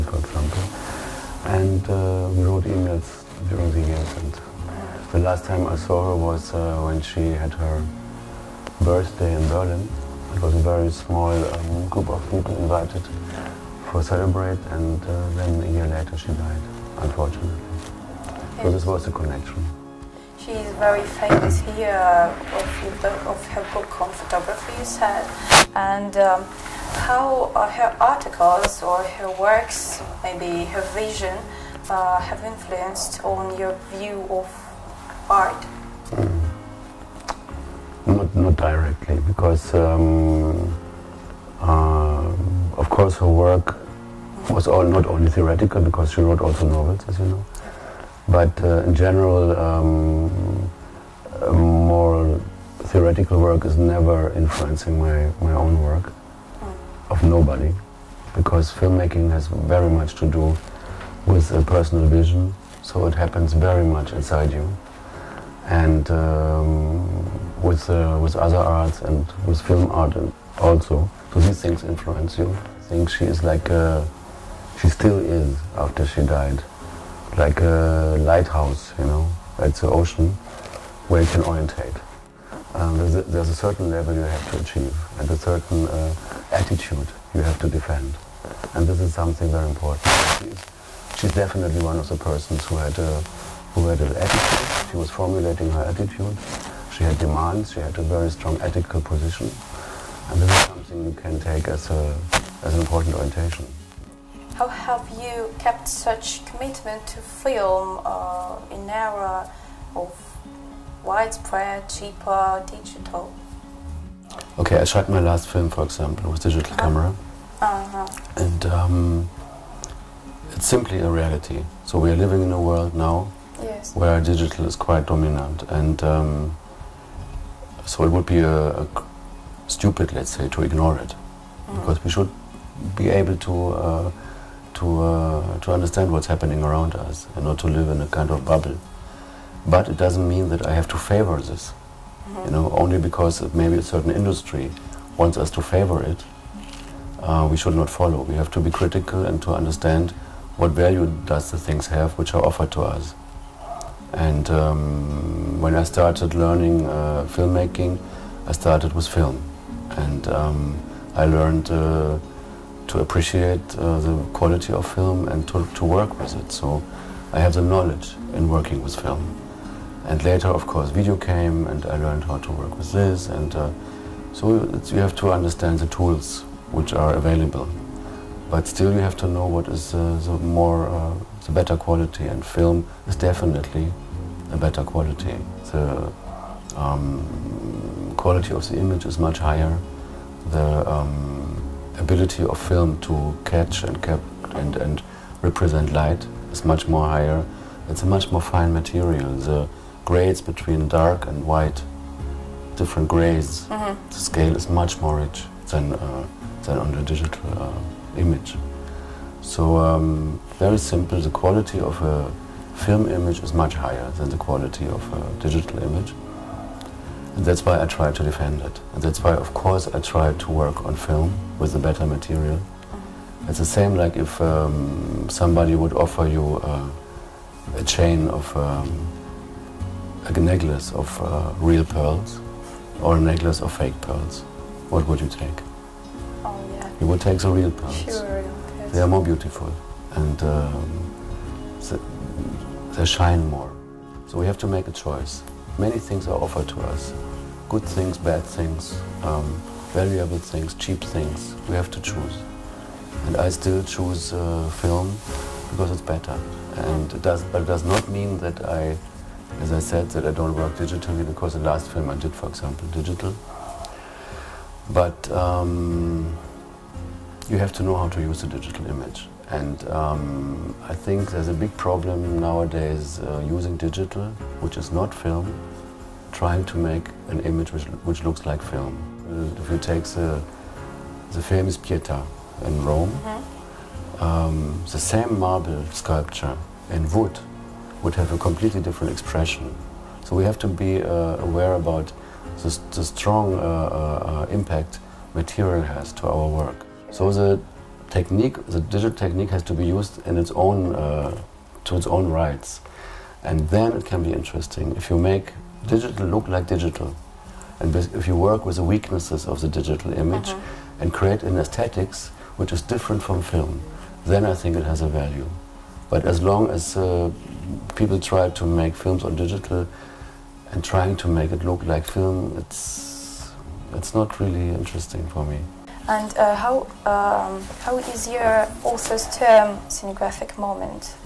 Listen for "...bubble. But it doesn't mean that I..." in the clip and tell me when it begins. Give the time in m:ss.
2:18.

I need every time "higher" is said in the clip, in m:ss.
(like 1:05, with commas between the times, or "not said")
3:09, 3:17, 3:33.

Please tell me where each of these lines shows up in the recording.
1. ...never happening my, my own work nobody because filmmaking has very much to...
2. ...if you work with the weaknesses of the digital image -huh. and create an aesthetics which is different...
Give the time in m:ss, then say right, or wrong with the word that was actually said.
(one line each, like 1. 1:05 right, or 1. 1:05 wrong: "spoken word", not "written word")
1. 0:53 wrong: "influencing", not "happening"
2. 5:07 right.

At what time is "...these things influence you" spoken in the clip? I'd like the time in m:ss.
1:11.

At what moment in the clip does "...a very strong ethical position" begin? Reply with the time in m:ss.
1:37.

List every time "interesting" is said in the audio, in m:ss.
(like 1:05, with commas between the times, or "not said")
5:04, 5:24.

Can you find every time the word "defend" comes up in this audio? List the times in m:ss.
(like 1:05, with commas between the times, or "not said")
1:27, 3:38.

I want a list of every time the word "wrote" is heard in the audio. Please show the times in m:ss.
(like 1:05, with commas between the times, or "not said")
0:02, 0:46.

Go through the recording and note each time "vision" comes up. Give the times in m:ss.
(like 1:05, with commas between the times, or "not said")
0:30, 1:02.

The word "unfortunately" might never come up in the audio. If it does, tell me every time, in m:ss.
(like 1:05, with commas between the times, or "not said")
0:16.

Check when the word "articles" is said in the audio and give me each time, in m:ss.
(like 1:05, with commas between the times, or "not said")
0:27.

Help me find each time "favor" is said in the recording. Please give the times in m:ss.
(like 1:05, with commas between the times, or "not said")
2:20, 2:25.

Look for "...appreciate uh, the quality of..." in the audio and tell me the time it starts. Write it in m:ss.
2:42.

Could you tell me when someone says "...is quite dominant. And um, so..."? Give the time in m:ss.
2:04.